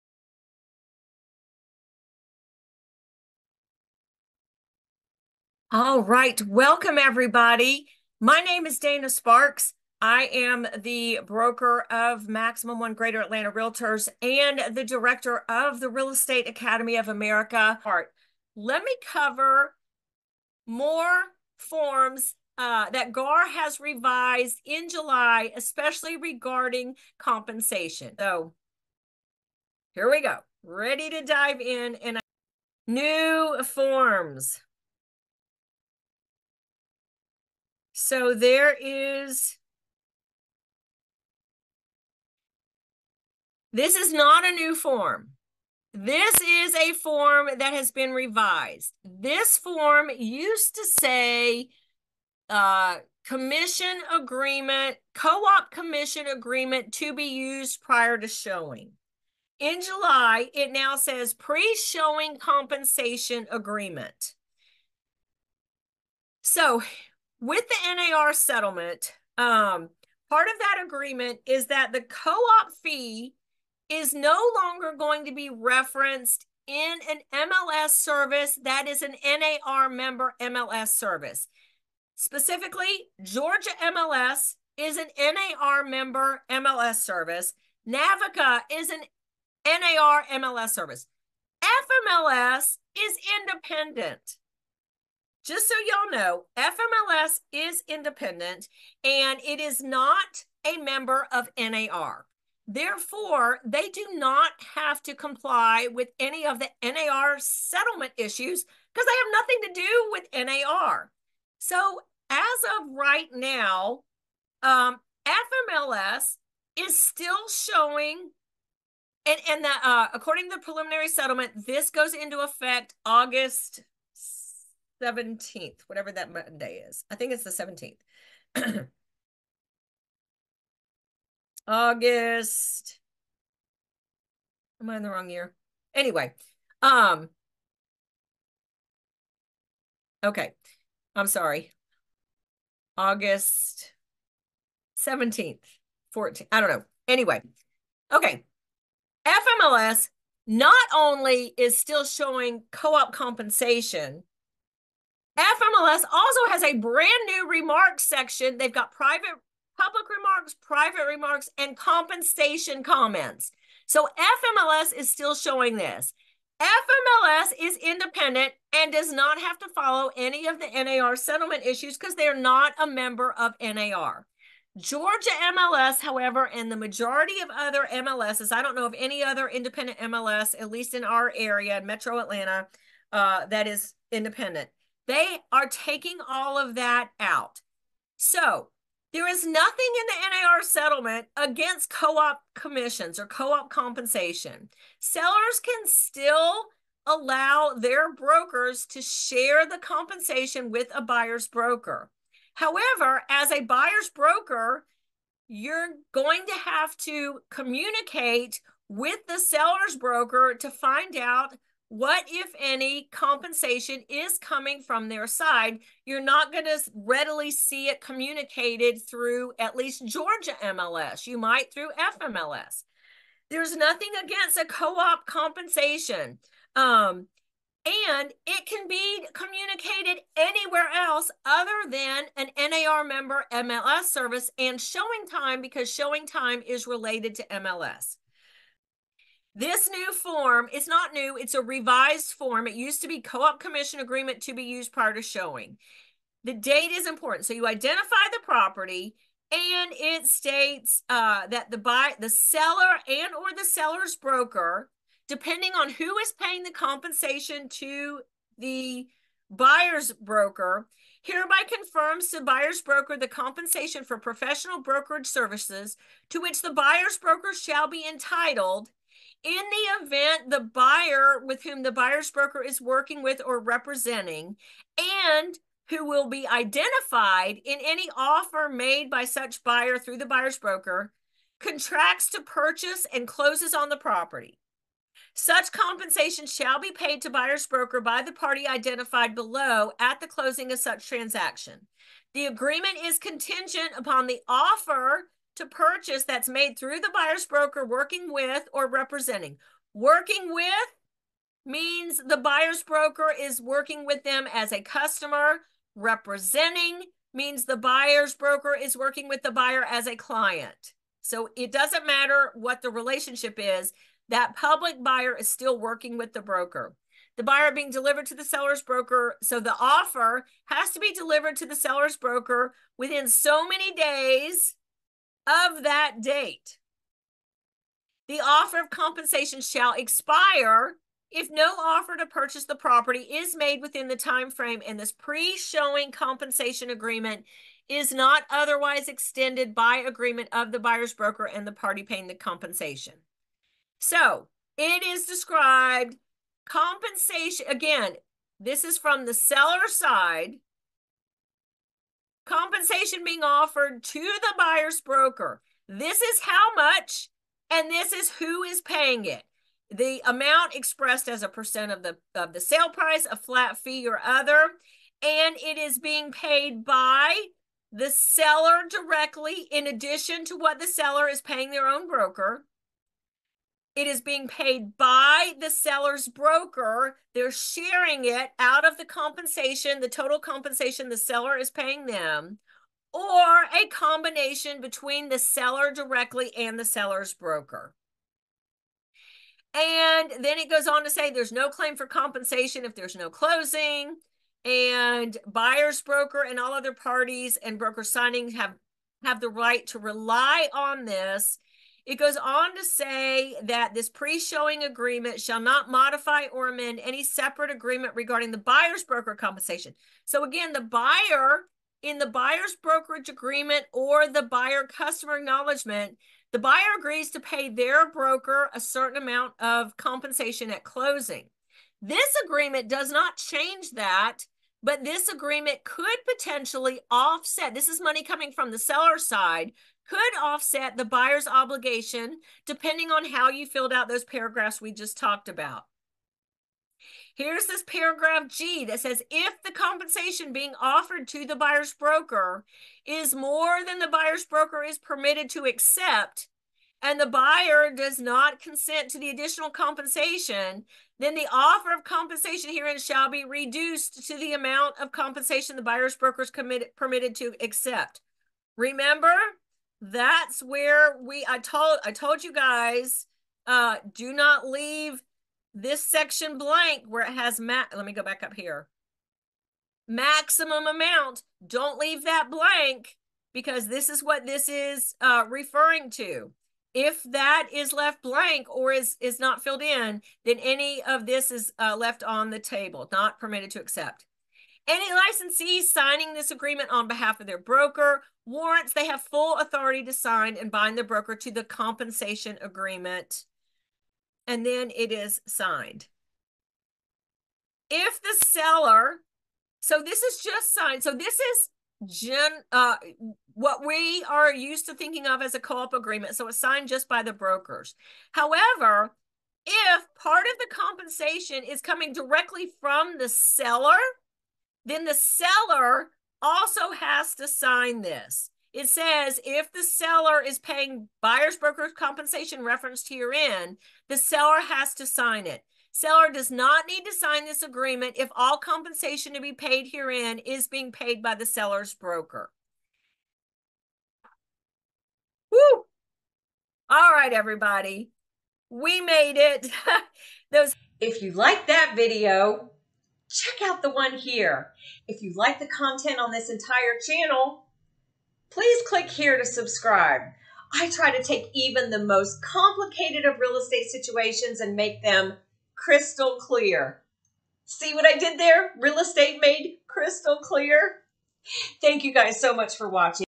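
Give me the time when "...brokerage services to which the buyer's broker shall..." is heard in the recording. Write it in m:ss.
4:24.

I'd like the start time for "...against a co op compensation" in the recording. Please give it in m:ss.
3:44.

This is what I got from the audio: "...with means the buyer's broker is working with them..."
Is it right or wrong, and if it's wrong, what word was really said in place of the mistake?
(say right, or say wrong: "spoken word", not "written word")
right.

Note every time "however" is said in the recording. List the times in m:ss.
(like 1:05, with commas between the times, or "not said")
2:55, 3:22, 8:28.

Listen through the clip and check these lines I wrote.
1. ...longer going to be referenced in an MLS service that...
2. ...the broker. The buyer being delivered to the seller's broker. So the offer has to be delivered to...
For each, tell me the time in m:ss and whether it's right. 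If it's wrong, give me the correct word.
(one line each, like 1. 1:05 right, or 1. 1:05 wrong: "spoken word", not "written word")
1. 1:14 right
2. 5:16 right.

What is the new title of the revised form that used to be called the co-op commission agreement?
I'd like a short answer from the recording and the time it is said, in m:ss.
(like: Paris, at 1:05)
Pre showing compensation agreement, at 1:01.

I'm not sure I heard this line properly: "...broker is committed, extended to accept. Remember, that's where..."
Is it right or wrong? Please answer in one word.
wrong.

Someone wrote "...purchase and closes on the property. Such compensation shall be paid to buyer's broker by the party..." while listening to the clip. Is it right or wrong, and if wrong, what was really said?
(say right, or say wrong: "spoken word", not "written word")
right.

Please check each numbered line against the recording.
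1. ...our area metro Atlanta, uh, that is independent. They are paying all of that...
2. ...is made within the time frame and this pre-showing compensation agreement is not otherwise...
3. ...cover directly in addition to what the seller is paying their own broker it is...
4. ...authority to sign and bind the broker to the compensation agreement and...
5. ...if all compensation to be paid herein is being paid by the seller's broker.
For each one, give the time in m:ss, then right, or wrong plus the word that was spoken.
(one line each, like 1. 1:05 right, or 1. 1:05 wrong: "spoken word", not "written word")
1. 3:01 wrong: "taking", not "paying"
2. 5:33 right
3. 6:08 wrong: "seller", not "cover"
4. 8:09 right
5. 8:48 right.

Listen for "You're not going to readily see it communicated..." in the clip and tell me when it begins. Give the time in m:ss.
3:36.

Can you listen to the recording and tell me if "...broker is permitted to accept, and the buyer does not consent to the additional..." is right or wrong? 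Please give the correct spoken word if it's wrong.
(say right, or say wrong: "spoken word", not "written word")
right.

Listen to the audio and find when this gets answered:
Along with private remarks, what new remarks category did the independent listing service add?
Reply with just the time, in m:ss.
2:41.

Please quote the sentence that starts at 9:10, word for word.
I try to take even the most complicated of real estate situations and make them crystal clear.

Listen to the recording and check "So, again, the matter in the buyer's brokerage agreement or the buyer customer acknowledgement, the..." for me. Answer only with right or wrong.
wrong.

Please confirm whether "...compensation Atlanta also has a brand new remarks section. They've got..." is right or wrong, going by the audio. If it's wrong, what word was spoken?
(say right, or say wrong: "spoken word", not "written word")
wrong: "FMLS", not "Atlanta".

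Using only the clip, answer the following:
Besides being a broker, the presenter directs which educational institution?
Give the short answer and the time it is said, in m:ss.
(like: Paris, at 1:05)
Real Estate Academy of America, at 0:15.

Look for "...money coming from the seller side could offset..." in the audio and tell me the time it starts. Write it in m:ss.
7:08.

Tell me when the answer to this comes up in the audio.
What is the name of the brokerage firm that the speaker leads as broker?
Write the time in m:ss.
0:12.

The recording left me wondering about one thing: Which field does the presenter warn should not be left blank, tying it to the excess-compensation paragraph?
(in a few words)
Maximum amount.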